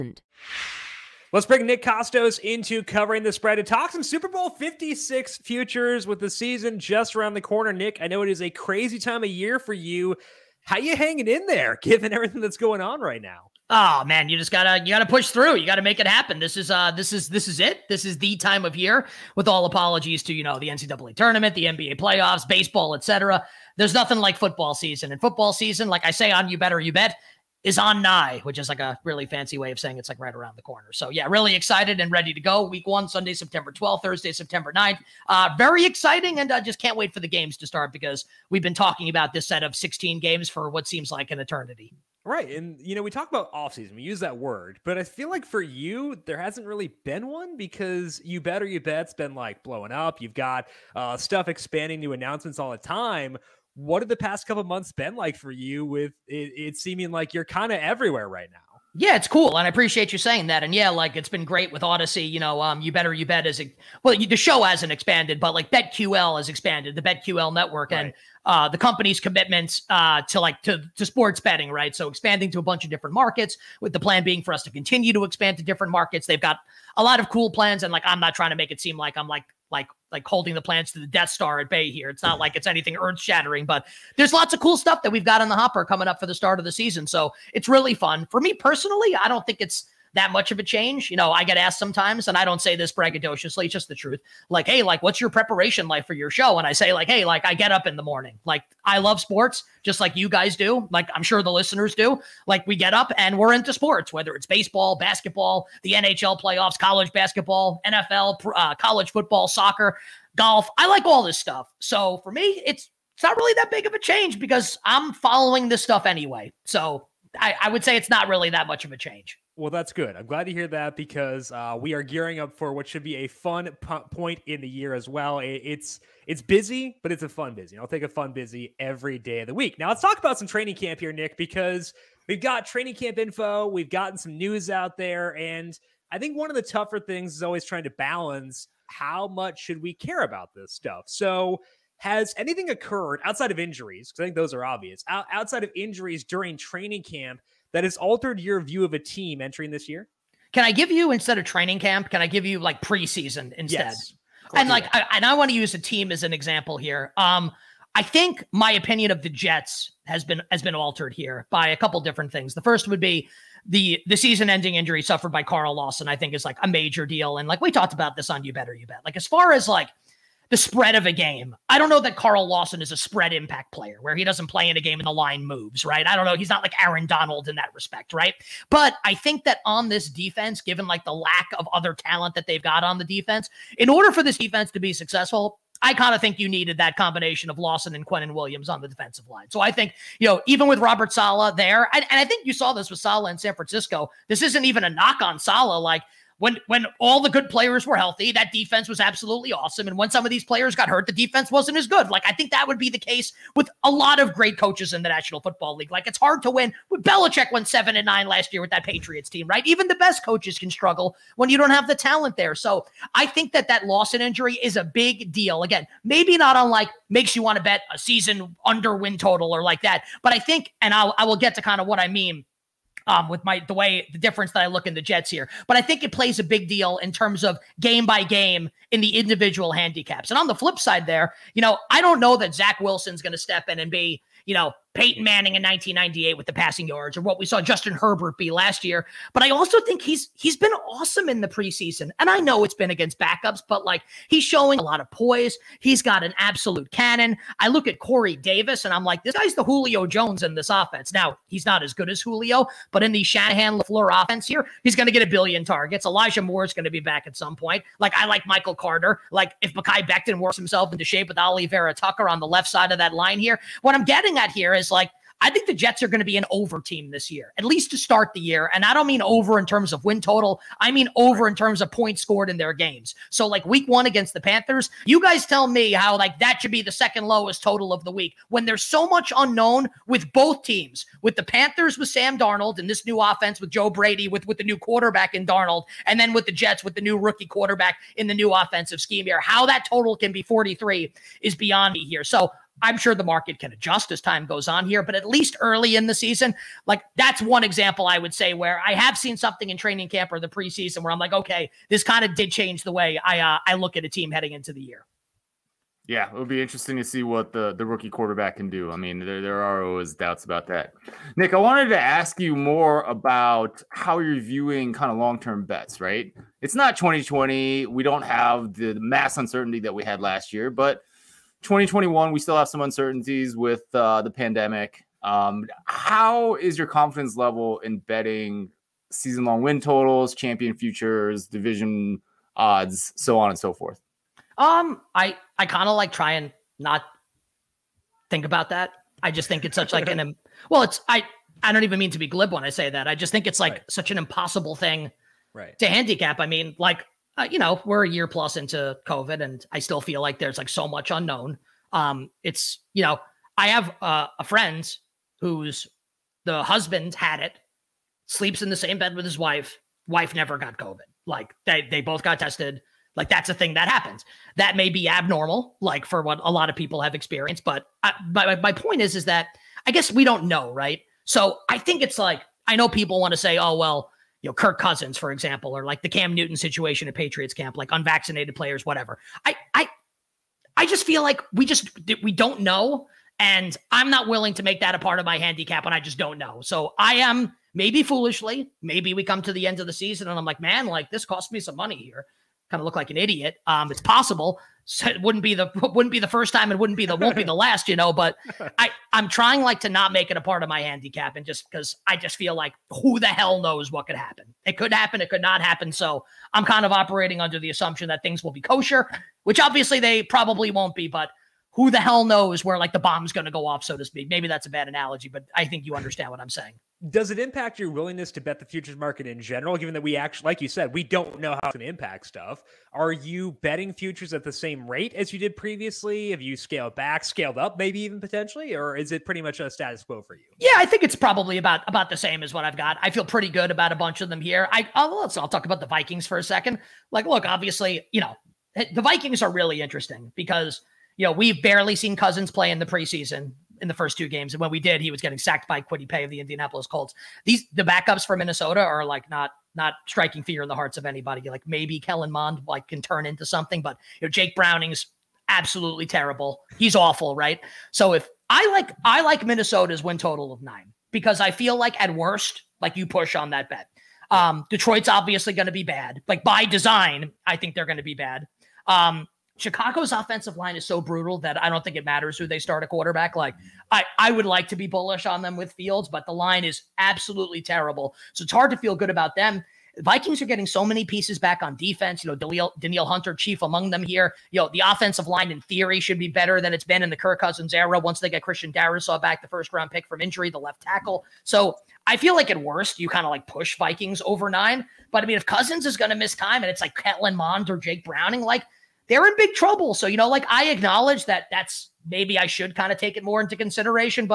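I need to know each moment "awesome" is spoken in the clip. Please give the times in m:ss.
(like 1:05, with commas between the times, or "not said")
3:19, 4:00.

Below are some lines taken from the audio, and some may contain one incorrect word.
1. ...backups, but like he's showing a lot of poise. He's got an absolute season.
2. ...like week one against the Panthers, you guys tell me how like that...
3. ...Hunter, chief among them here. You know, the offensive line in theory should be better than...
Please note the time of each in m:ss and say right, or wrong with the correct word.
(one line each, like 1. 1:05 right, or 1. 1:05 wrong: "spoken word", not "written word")
1. 4:03 wrong: "cannon", not "season"
2. 4:33 right
3. 8:03 right.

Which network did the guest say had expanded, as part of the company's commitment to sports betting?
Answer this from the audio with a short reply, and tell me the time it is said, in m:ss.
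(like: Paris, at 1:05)
BetQL network, at 1:06.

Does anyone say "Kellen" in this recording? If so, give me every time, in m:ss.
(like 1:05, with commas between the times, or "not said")
7:31, 8:16.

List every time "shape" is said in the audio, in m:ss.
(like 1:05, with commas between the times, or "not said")
4:21.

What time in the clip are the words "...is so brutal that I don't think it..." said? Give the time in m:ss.
7:50.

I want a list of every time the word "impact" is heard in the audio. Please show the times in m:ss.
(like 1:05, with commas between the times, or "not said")
2:53, 6:57, 7:01.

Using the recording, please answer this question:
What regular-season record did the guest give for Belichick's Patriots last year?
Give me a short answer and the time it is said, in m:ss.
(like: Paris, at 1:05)
7 and 9, at 3:27.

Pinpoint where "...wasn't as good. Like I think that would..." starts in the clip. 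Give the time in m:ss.
3:21.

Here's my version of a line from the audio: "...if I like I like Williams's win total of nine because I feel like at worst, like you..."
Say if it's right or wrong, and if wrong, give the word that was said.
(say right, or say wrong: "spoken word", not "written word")
wrong: "Minnesota", not "Williams".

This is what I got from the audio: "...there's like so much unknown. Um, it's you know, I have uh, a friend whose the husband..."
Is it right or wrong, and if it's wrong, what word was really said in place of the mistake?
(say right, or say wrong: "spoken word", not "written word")
right.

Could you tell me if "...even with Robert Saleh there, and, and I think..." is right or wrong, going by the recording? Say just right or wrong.
right.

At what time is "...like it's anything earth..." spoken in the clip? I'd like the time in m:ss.
1:22.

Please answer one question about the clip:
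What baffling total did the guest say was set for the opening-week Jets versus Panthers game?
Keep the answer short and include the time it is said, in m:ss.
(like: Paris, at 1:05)
43, at 4:50.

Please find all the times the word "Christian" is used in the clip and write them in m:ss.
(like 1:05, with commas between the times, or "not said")
8:08.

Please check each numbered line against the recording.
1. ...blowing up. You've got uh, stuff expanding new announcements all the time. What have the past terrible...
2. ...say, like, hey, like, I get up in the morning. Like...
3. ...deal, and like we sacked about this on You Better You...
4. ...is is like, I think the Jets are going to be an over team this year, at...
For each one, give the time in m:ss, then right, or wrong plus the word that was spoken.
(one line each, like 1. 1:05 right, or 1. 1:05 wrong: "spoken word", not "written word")
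1. 0:49 wrong: "couple", not "terrible"
2. 1:36 right
3. 2:47 wrong: "talked", not "sacked"
4. 4:24 right.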